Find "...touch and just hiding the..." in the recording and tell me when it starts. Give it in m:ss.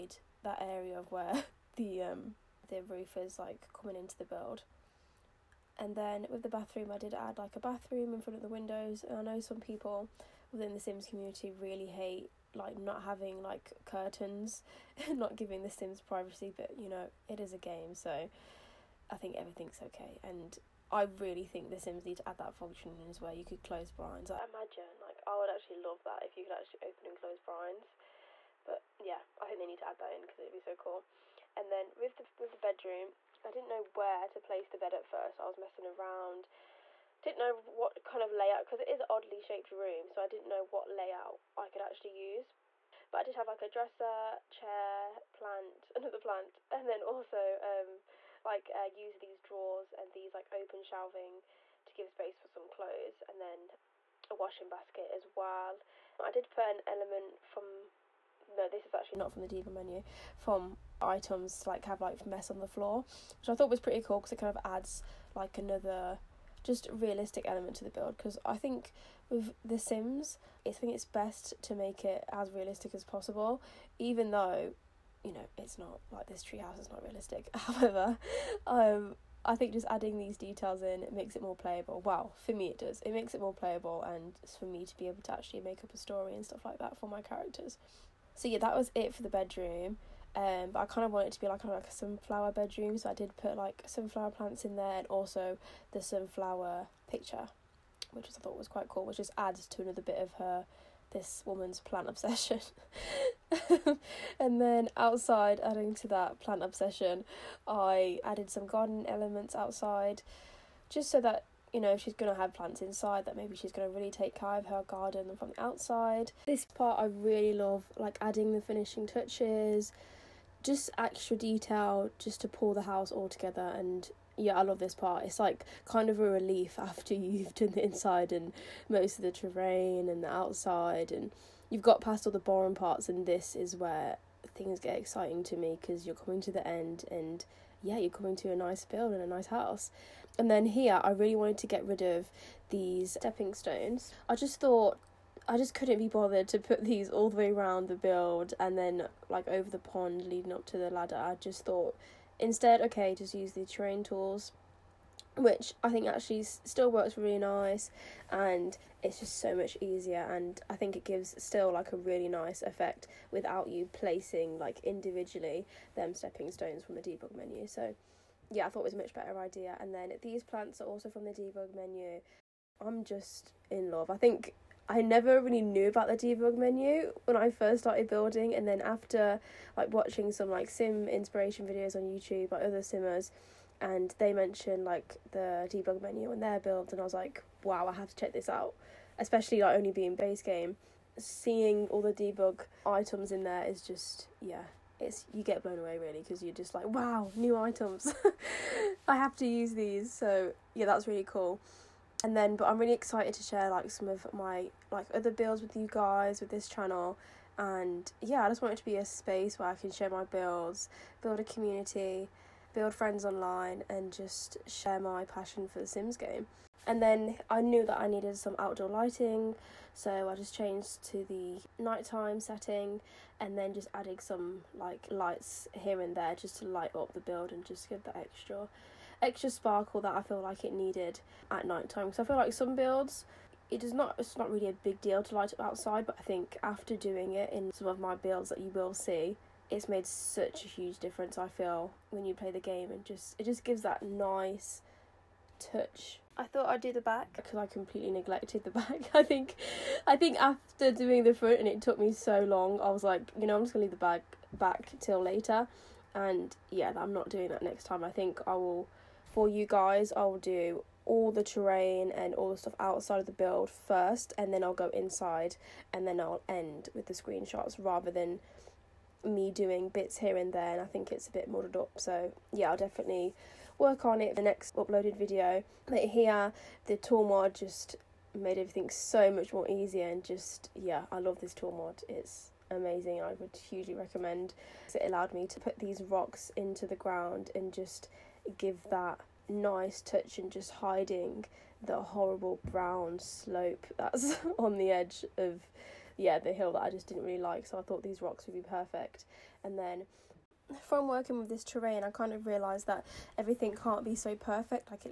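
4:50.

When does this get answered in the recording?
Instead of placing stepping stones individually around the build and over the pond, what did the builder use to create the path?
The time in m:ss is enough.
2:33.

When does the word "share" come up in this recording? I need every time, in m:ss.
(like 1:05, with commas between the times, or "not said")
3:23, 3:29, 3:34.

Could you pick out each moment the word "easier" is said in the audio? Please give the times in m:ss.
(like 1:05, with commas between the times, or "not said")
2:39, 4:39.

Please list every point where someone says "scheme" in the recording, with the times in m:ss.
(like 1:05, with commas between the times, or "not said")
not said.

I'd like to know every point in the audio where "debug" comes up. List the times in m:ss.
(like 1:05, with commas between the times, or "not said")
0:59, 2:47, 2:51, 2:56, 3:05, 3:12.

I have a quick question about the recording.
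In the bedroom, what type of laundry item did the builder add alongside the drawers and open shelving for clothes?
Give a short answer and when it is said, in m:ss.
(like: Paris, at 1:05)
Washing basket, at 0:54.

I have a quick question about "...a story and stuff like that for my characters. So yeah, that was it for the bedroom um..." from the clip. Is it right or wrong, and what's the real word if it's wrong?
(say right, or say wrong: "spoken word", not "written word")
right.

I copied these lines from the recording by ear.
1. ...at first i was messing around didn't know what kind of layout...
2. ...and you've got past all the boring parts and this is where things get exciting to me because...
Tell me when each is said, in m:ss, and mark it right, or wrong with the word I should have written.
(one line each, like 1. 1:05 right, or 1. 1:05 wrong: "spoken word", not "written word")
1. 0:34 right
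2. 2:11 right.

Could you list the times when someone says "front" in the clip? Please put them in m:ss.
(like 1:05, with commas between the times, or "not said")
0:08, 4:11.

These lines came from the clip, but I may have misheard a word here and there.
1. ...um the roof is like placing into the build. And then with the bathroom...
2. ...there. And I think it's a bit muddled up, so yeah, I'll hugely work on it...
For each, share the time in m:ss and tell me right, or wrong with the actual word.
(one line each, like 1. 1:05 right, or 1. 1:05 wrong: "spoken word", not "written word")
1. 0:02 wrong: "coming", not "placing"
2. 4:30 wrong: "definitely", not "hugely".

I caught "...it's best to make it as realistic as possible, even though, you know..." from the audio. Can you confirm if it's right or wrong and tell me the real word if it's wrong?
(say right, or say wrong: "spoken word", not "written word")
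right.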